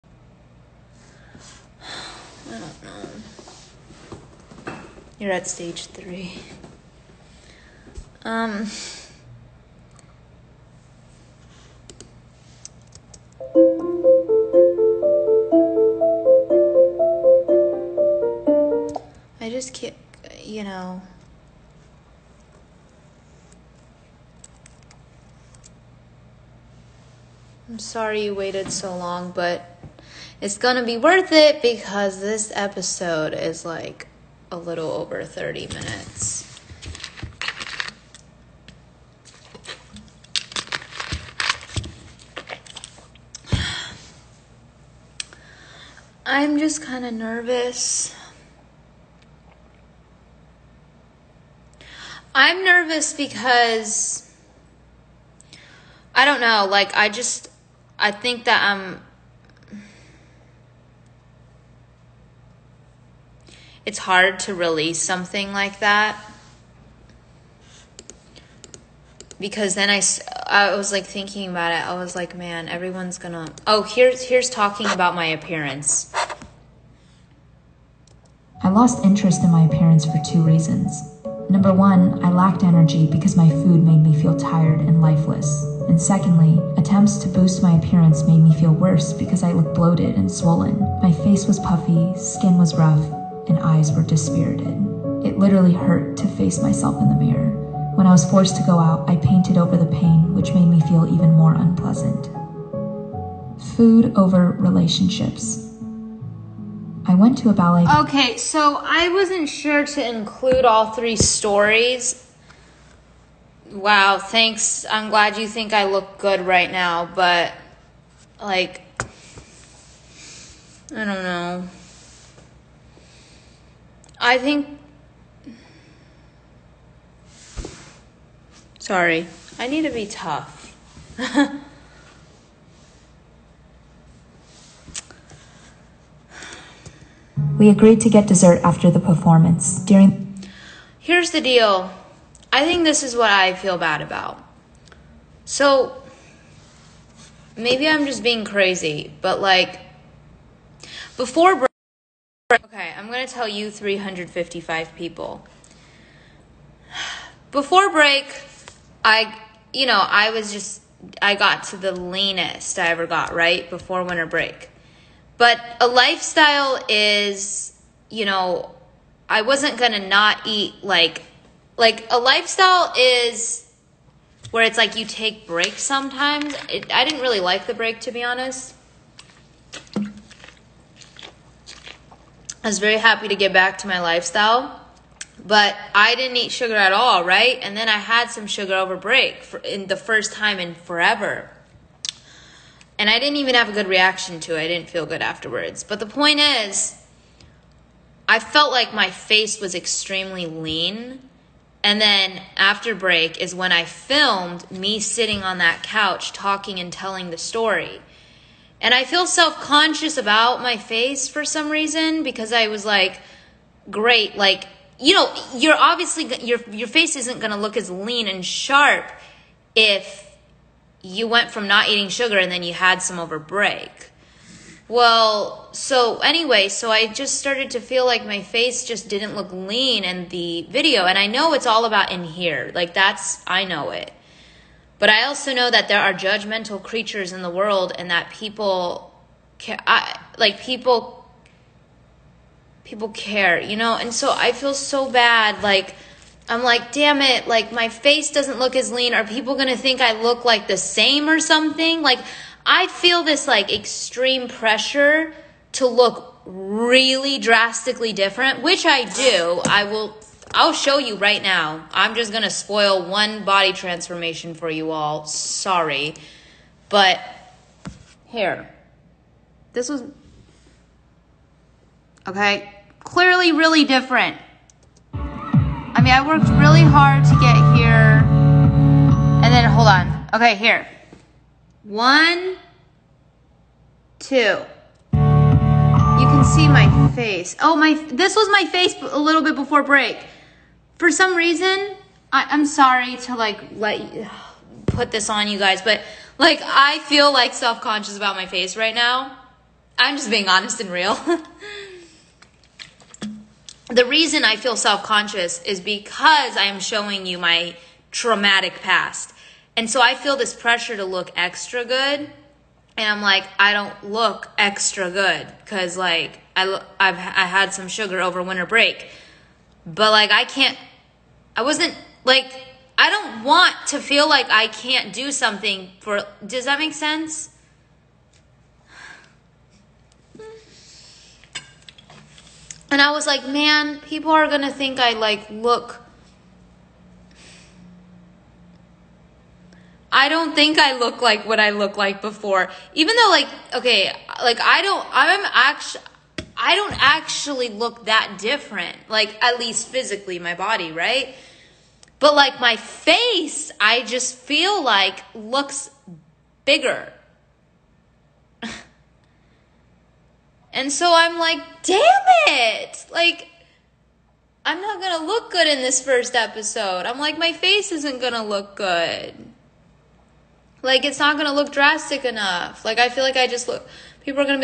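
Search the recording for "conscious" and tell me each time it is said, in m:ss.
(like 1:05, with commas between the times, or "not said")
3:29, 4:57, 5:05.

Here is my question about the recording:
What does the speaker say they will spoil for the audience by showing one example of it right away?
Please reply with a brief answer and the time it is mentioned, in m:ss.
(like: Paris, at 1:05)
body transformation, at 4:23.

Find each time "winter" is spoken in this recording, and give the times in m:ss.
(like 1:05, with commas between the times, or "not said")
2:44, 5:18.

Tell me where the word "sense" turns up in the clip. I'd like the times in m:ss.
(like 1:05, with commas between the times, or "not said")
5:26.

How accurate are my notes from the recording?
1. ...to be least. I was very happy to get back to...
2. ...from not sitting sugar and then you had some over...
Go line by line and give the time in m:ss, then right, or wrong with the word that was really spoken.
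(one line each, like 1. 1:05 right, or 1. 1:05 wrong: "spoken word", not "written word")
1. 2:58 wrong: "honest", not "least"
2. 3:41 wrong: "eating", not "sitting".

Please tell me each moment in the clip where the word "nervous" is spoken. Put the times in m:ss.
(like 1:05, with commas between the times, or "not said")
0:47, 0:52.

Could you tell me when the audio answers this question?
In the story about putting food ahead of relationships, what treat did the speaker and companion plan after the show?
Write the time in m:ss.
2:18.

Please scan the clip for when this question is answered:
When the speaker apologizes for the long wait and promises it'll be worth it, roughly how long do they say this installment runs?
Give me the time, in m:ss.
0:35.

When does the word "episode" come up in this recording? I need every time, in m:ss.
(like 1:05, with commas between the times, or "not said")
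0:32, 6:06.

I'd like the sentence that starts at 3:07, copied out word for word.
And then I had some sugar over break for, in the first time in forever.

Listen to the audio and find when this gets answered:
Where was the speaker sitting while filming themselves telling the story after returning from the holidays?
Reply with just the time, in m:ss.
3:25.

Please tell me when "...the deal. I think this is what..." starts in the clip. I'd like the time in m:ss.
2:21.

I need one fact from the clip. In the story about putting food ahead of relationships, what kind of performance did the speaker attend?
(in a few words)
ballet.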